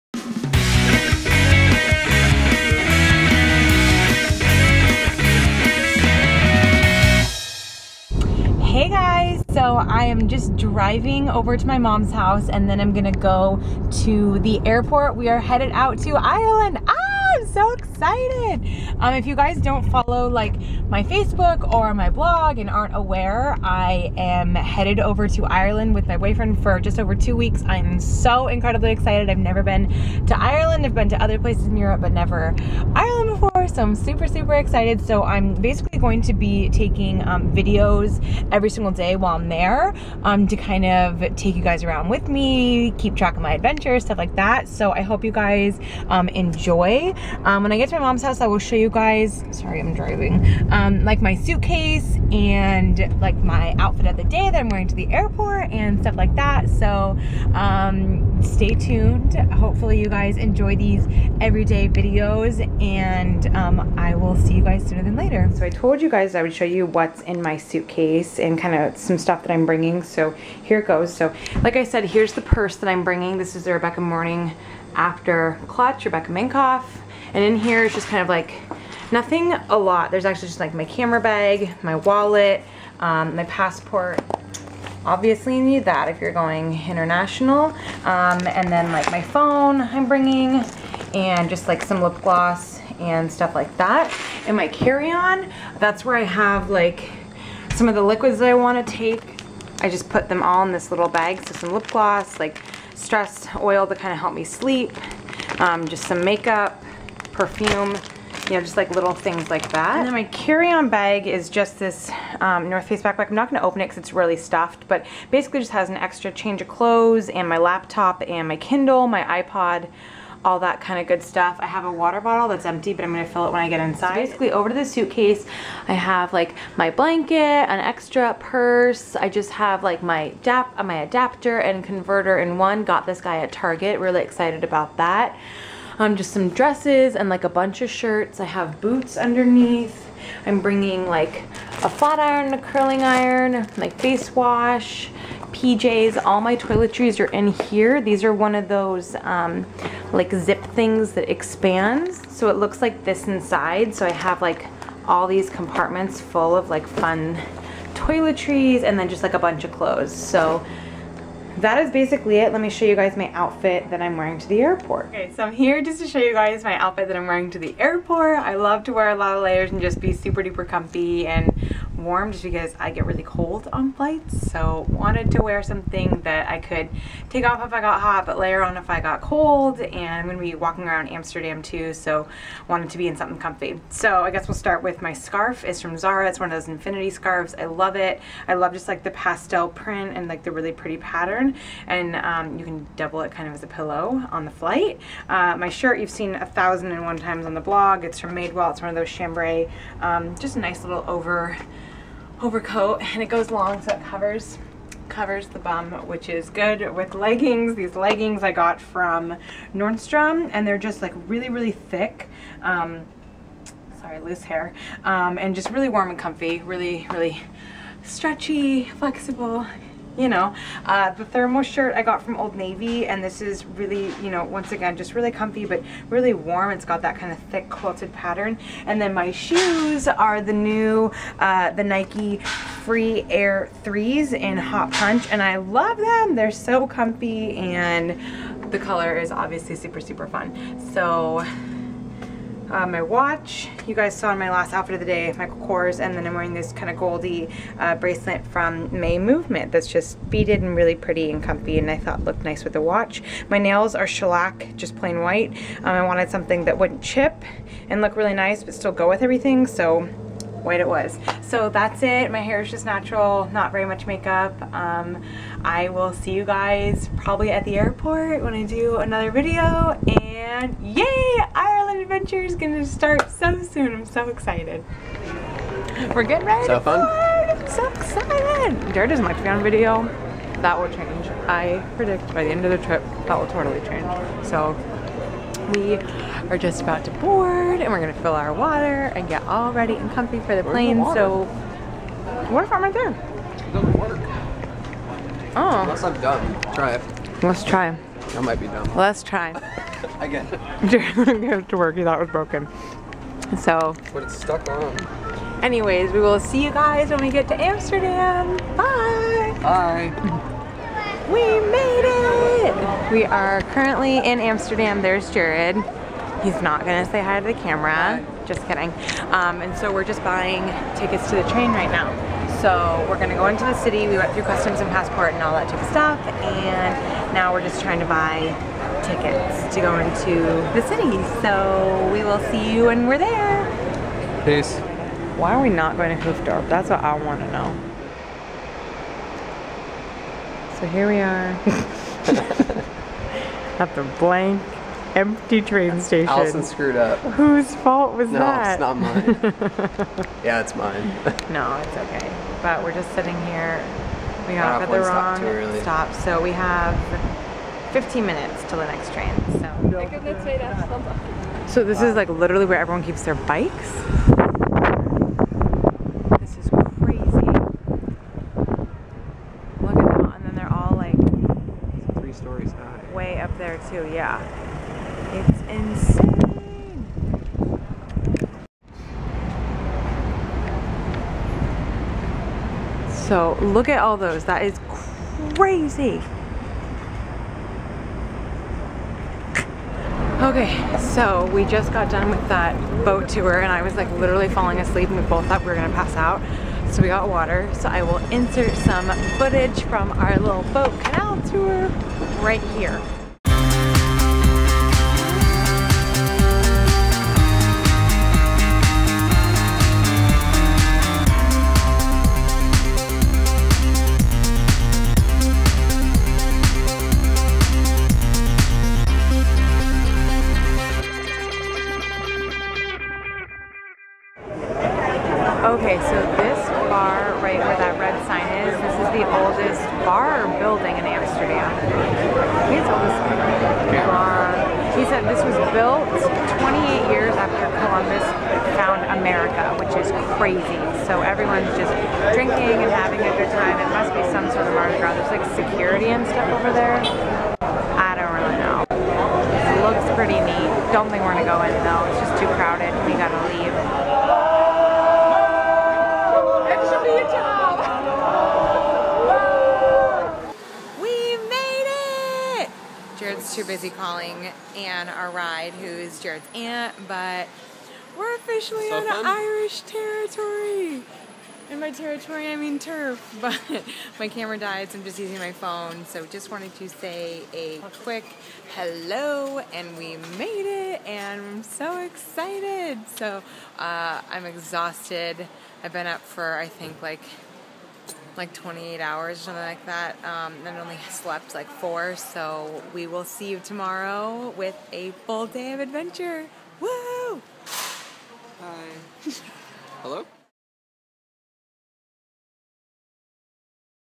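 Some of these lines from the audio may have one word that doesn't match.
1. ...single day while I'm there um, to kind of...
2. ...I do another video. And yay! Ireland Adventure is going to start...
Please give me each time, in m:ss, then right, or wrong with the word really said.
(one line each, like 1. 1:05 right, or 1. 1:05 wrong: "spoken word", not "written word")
1. 0:38 right
2. 4:28 right.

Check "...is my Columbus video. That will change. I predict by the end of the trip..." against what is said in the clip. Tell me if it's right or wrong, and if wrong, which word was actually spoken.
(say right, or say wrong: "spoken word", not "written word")
wrong: "Patreon", not "Columbus".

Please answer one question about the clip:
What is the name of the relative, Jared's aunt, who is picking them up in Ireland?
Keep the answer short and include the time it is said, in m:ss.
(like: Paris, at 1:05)
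Anne, at 7:44.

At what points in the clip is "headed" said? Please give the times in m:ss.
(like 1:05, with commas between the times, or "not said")
0:15, 0:24.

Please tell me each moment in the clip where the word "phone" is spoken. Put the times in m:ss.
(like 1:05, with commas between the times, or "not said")
1:29, 7:55.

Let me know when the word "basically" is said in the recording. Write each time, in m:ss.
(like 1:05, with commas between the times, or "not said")
0:35, 1:55, 2:04, 2:41.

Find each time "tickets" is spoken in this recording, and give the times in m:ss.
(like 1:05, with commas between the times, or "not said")
5:20, 5:29.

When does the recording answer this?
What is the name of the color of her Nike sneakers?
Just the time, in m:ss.
3:54.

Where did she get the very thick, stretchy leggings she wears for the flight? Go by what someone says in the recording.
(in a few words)
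Nordstrom.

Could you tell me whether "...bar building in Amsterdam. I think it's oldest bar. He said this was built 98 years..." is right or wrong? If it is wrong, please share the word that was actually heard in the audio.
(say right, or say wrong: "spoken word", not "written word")
wrong: "28", not "98".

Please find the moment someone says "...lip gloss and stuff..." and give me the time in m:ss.
1:32.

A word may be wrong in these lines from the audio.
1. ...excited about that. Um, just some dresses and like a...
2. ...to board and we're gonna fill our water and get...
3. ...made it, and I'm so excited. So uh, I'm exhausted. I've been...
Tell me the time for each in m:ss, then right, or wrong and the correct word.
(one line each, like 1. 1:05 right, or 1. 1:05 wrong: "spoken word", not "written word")
1. 2:14 right
2. 4:47 right
3. 8:00 right.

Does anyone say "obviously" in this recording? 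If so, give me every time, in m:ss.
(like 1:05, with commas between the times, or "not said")
1:25, 3:59.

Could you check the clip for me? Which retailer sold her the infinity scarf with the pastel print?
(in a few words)
Zara.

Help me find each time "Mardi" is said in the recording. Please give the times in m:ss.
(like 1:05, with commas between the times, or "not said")
7:24.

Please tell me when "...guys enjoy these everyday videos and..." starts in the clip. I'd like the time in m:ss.
1:00.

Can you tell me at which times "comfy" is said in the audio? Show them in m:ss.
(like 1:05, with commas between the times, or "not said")
2:50, 3:03, 3:36, 3:45, 3:56, 4:11, 4:50.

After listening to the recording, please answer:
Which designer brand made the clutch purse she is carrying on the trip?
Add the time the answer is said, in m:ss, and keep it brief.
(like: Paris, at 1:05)
Rebecca Minkoff, at 1:16.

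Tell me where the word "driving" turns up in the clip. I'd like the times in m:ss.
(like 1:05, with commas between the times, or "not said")
0:10, 0:49.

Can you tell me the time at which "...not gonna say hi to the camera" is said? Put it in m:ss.
5:16.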